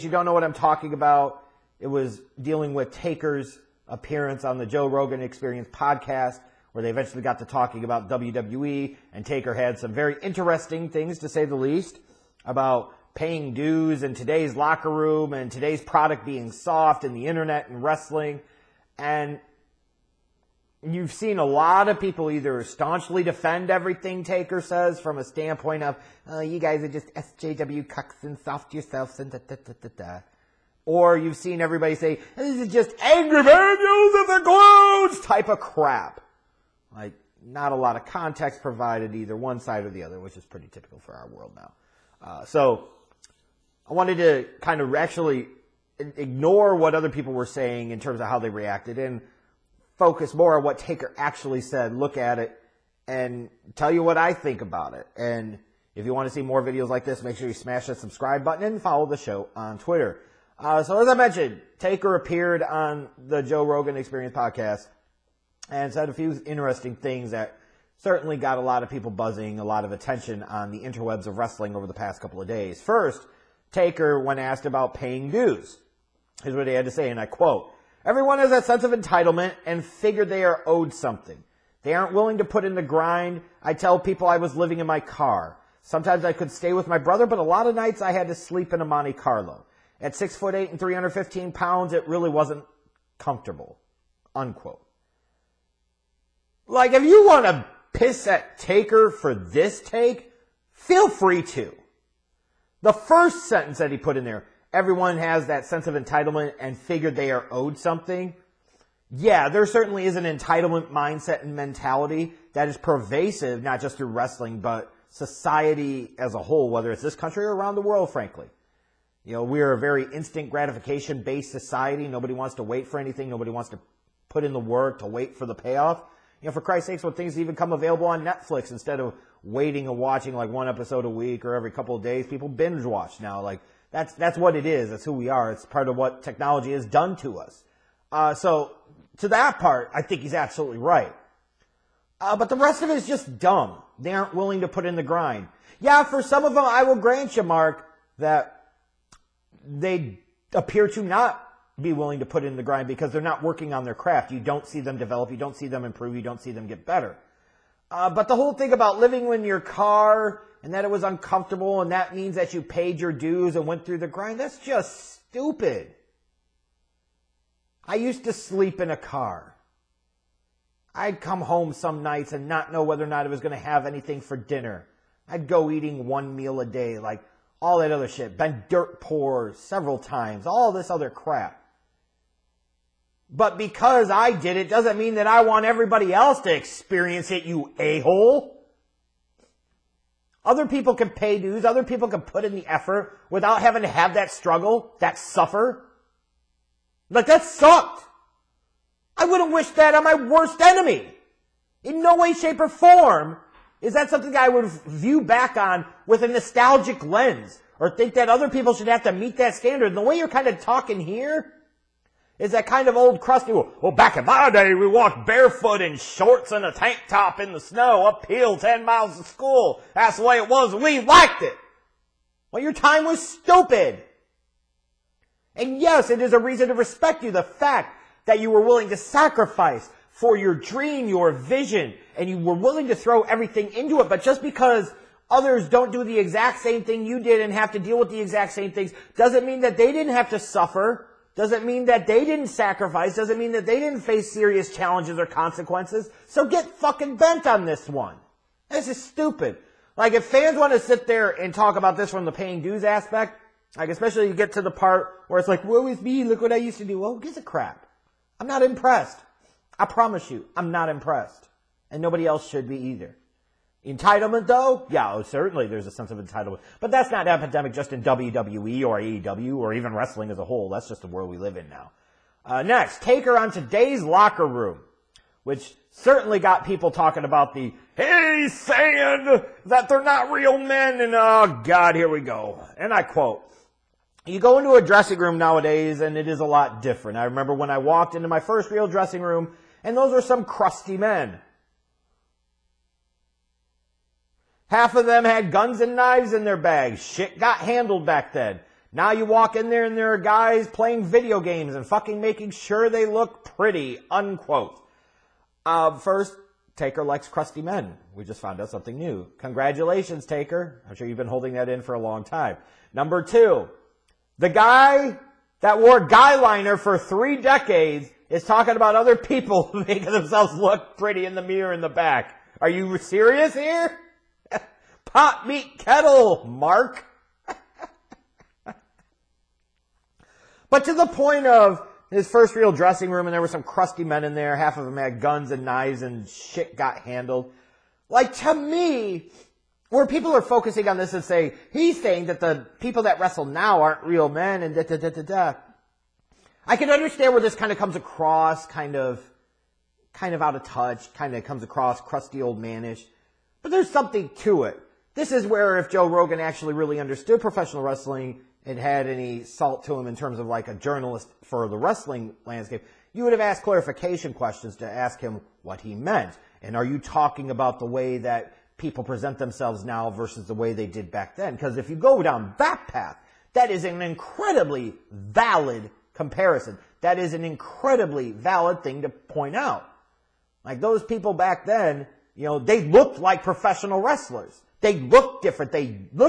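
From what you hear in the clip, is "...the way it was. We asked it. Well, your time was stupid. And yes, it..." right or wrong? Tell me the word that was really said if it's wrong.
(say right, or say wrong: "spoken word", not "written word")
wrong: "liked", not "asked".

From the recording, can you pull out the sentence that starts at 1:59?
You know, we are a very instant gratification based society.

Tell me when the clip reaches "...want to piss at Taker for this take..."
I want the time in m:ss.
1:37.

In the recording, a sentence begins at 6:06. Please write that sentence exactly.
And are you talking about the way that people present themselves now versus the way they did back then?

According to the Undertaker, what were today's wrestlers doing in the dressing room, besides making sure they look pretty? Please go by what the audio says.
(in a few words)
Playing video games.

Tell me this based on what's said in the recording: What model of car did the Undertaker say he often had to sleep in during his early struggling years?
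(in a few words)
Monte Carlo.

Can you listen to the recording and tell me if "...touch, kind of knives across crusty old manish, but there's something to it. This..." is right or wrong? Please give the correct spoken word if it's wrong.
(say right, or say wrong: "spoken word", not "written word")
wrong: "comes", not "knives".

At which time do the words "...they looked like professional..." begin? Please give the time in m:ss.
6:22.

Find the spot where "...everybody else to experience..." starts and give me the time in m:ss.
3:05.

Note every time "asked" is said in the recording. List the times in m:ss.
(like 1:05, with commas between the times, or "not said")
1:14, 6:03.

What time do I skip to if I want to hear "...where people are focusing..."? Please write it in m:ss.
5:39.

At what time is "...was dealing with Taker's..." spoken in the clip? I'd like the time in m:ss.
0:01.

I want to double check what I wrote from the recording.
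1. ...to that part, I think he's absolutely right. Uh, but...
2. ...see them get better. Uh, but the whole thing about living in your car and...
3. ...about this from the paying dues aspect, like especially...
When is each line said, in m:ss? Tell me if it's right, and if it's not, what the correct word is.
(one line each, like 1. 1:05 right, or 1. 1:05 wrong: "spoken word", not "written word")
1. 2:19 right
2. 2:36 right
3. 4:11 right.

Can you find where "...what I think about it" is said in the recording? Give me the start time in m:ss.
0:54.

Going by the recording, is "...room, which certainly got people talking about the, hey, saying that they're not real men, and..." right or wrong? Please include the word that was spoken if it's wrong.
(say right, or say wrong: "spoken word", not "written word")
right.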